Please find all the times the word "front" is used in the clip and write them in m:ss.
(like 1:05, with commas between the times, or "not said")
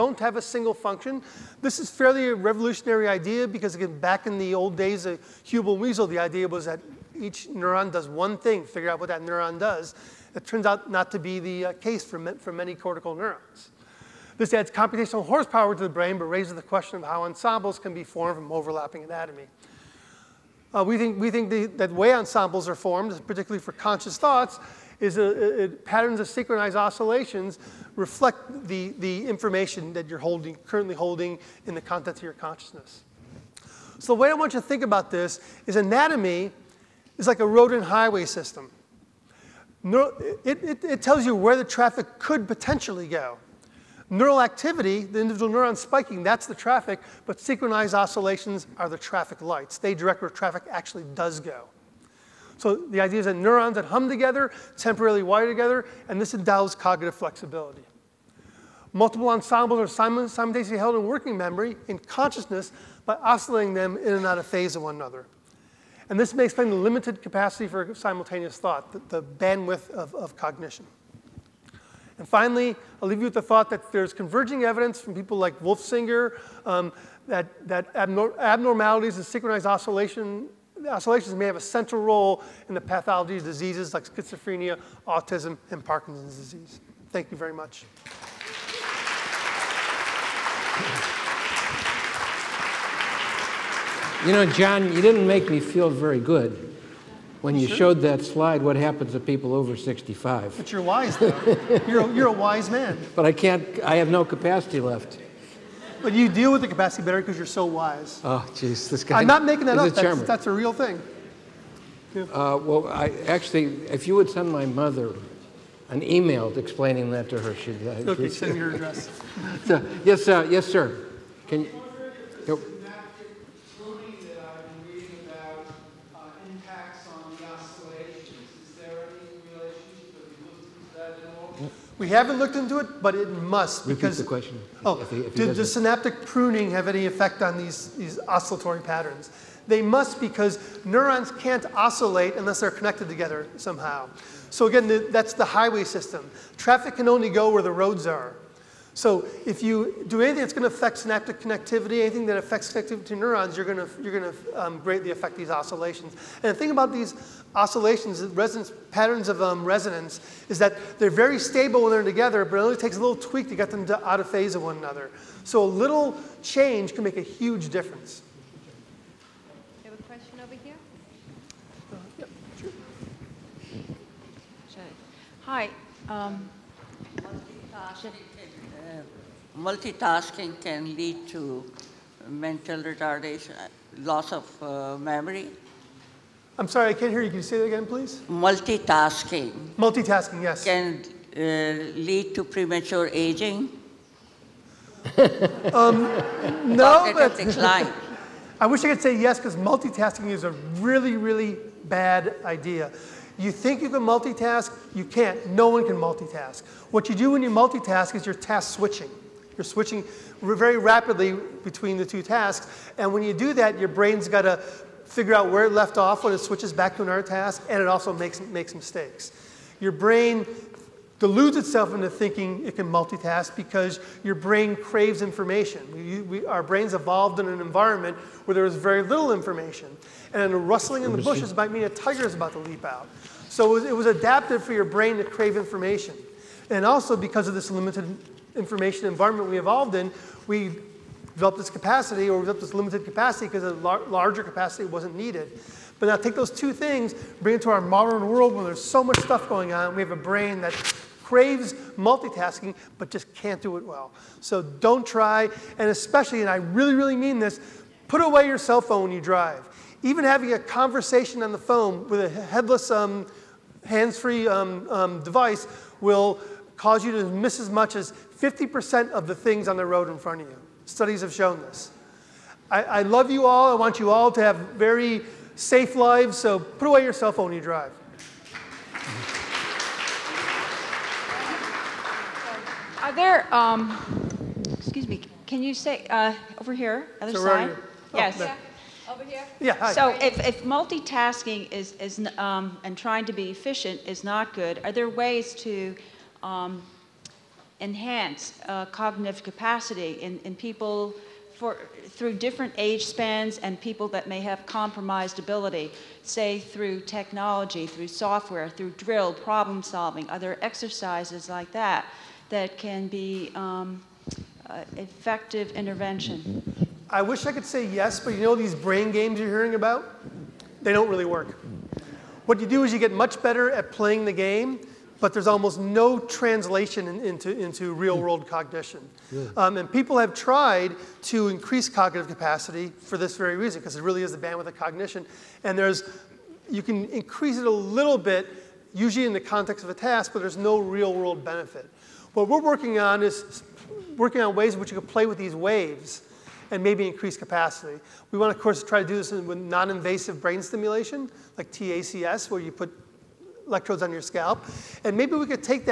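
4:30.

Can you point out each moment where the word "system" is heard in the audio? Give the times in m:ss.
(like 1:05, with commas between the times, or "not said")
0:38, 2:25.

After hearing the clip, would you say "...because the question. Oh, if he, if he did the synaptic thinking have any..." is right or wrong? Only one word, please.
wrong.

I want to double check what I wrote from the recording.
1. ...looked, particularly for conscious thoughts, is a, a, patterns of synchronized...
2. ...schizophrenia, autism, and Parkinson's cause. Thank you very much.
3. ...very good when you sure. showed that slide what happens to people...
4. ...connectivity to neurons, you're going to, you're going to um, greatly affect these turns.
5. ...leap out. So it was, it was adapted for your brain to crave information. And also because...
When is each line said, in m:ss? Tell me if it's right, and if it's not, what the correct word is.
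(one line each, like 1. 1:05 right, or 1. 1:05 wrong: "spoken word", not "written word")
1. 0:22 wrong: "formed", not "looked"
2. 1:24 wrong: "disease", not "cause"
3. 1:35 right
4. 2:32 wrong: "oscillations", not "turns"
5. 3:52 right.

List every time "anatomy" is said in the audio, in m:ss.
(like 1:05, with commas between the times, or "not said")
0:19, 0:35.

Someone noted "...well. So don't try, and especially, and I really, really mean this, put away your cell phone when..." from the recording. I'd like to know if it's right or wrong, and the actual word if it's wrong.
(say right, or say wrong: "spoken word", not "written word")
right.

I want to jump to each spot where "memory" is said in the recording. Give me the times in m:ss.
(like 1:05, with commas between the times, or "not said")
1:01, 3:04.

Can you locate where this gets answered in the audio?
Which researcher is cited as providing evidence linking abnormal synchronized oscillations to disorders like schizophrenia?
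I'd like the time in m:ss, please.
1:15.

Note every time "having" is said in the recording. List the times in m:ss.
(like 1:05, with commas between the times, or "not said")
4:20.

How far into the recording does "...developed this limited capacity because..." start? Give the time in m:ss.
4:02.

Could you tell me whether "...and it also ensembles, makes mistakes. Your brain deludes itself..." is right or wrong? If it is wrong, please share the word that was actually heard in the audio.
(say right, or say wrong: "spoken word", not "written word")
wrong: "makes", not "ensembles".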